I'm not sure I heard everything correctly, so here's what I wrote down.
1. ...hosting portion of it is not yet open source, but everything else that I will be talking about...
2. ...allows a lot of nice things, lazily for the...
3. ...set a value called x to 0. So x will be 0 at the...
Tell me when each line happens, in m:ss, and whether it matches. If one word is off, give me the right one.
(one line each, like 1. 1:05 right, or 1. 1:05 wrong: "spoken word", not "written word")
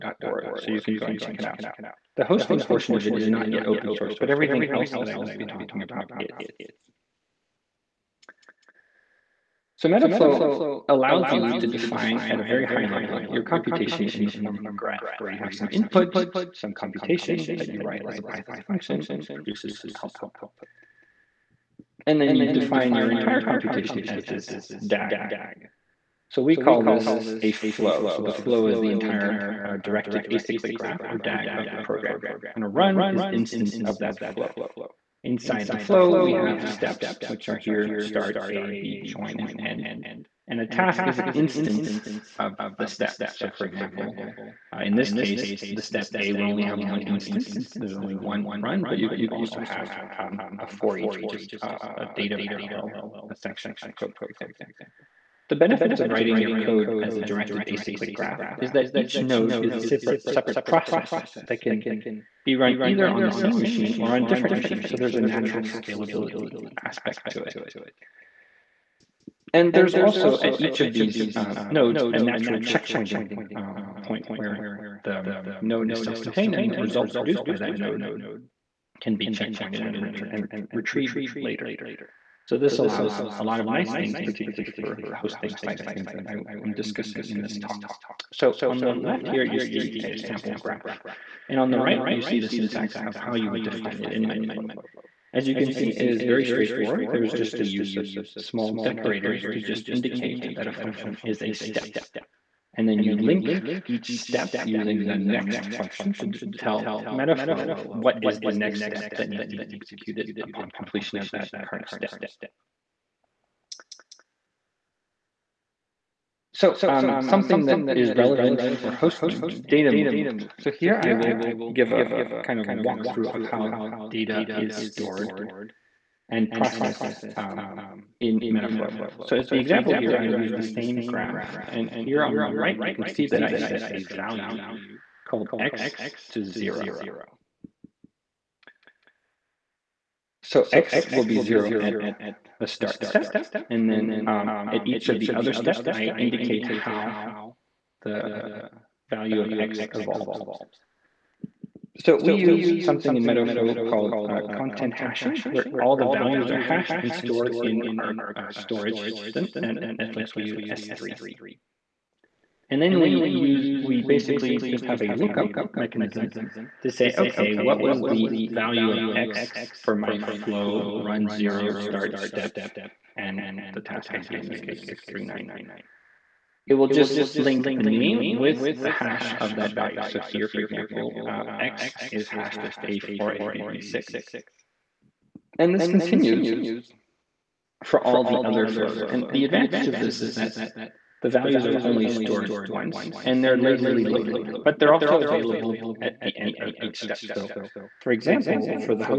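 1. 0:02 right
2. 1:22 wrong: "particularly", not "lazily"
3. 2:13 right.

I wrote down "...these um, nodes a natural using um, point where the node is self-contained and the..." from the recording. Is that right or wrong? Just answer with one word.
wrong.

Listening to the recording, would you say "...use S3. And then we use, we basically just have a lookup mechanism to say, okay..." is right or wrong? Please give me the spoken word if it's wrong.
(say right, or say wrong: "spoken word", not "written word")
right.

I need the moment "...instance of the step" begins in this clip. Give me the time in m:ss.
0:41.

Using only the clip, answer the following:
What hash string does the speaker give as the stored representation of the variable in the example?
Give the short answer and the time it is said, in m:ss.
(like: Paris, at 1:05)
A4ABB6, at 3:02.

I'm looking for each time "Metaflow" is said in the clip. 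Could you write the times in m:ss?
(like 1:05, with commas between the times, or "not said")
0:09, 1:34, 1:47, 2:08, 2:33.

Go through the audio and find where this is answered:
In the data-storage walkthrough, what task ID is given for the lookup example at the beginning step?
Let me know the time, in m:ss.
2:54.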